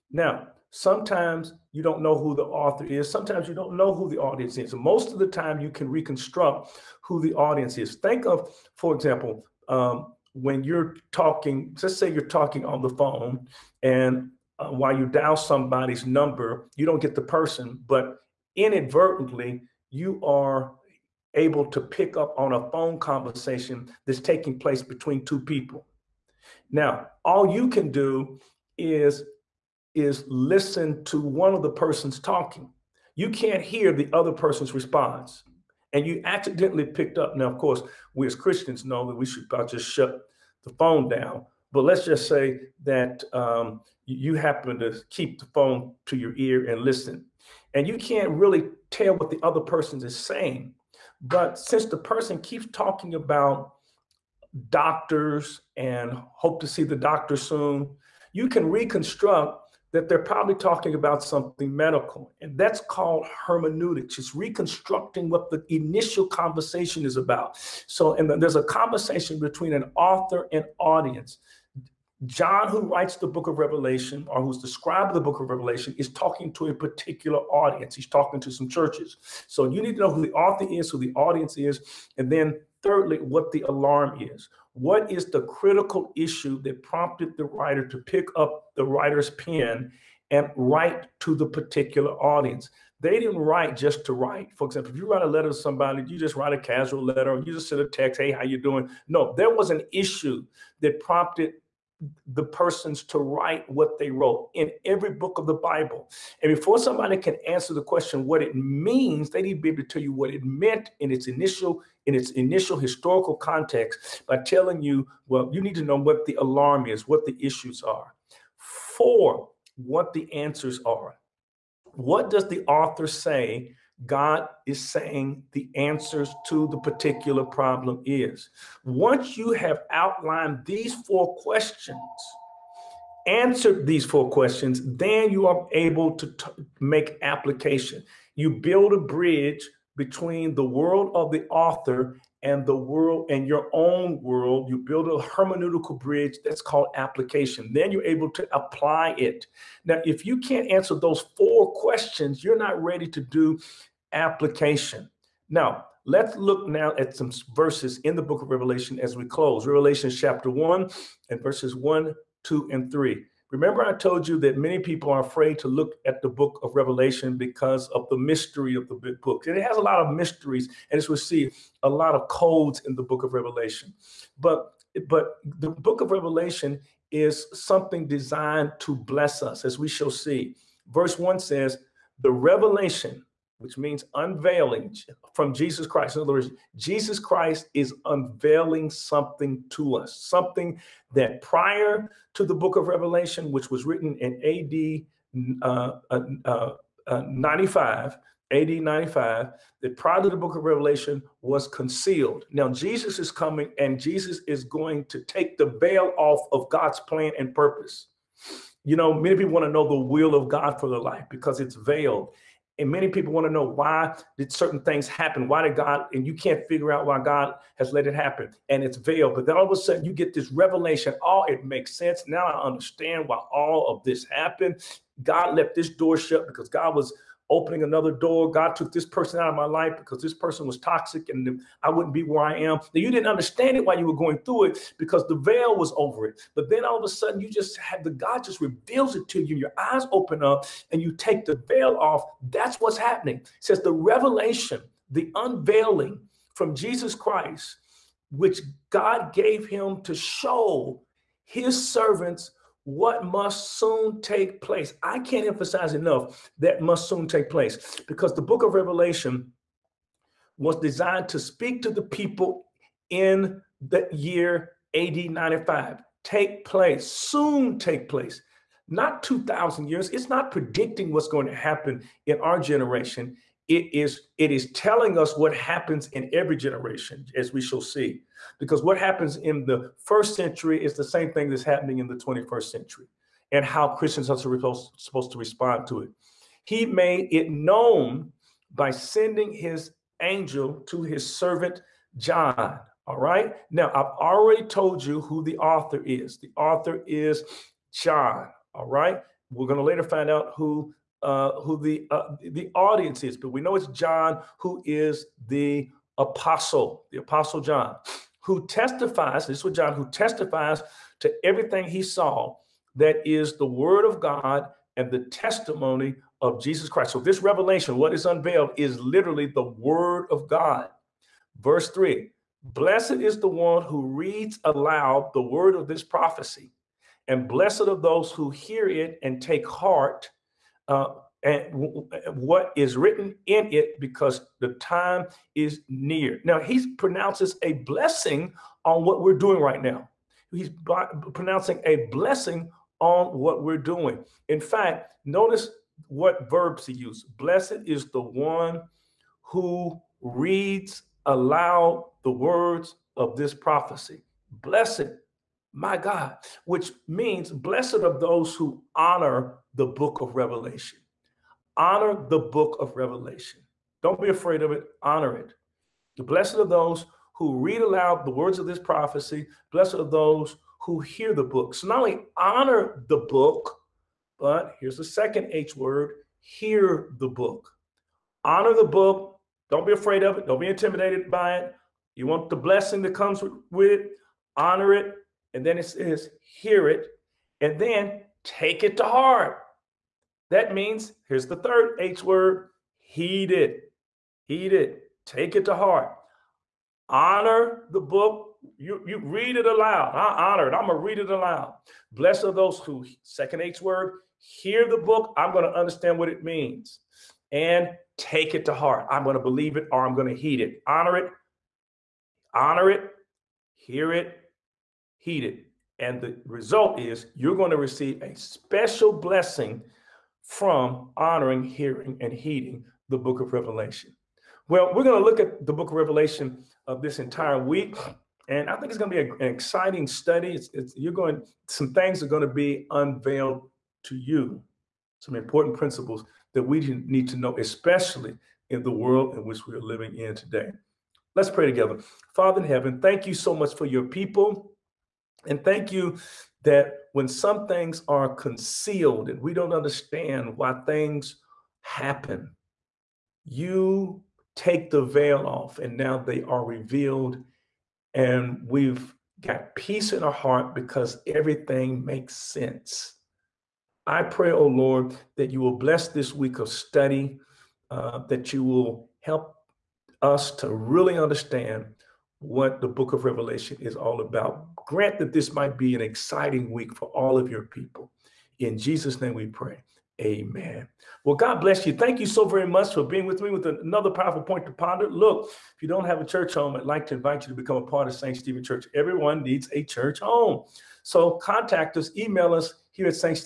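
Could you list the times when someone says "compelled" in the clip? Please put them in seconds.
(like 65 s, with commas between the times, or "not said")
not said.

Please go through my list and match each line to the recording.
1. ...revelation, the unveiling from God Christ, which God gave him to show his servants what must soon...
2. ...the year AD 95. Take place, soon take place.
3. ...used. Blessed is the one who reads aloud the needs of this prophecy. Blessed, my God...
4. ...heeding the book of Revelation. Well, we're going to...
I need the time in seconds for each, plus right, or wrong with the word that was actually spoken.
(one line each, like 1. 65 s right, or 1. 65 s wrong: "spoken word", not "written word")
1. 243 s wrong: "Jesus", not "God"
2. 263 s right
3. 346 s wrong: "words", not "needs"
4. 422 s right.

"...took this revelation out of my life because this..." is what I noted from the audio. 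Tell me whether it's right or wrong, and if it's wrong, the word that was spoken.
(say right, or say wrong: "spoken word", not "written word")
wrong: "person", not "revelation".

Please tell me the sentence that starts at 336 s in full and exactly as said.
Now, he pronounces a blessing on what we're doing right now.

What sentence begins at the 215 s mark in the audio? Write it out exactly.
Why did God, and you can't figure out why God has let it happen.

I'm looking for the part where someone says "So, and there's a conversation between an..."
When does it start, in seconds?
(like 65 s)
67 s.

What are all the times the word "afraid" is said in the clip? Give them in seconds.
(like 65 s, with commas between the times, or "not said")
165 s, 364 s, 379 s.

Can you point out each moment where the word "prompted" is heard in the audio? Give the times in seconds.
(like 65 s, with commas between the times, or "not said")
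86 s, 100 s.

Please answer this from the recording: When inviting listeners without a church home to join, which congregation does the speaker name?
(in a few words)
St. Stephen Church.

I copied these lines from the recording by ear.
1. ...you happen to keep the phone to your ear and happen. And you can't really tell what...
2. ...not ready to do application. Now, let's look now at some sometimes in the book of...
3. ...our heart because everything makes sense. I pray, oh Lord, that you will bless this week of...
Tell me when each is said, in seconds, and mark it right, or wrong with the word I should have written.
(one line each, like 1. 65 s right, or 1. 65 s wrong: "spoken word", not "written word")
1. 44 s wrong: "listen", not "happen"
2. 152 s wrong: "verses", not "sometimes"
3. 460 s right.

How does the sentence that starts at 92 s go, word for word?
They didn't write just to write.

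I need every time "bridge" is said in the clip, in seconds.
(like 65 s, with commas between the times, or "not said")
138 s, 145 s.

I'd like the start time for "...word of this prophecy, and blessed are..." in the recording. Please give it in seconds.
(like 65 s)
325 s.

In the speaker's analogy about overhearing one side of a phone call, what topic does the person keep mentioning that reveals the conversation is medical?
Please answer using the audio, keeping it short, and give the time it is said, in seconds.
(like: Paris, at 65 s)
doctors, at 54 s.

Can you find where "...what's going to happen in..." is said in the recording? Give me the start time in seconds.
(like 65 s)
271 s.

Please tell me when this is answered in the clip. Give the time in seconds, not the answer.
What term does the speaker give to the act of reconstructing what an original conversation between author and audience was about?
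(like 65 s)
63 s.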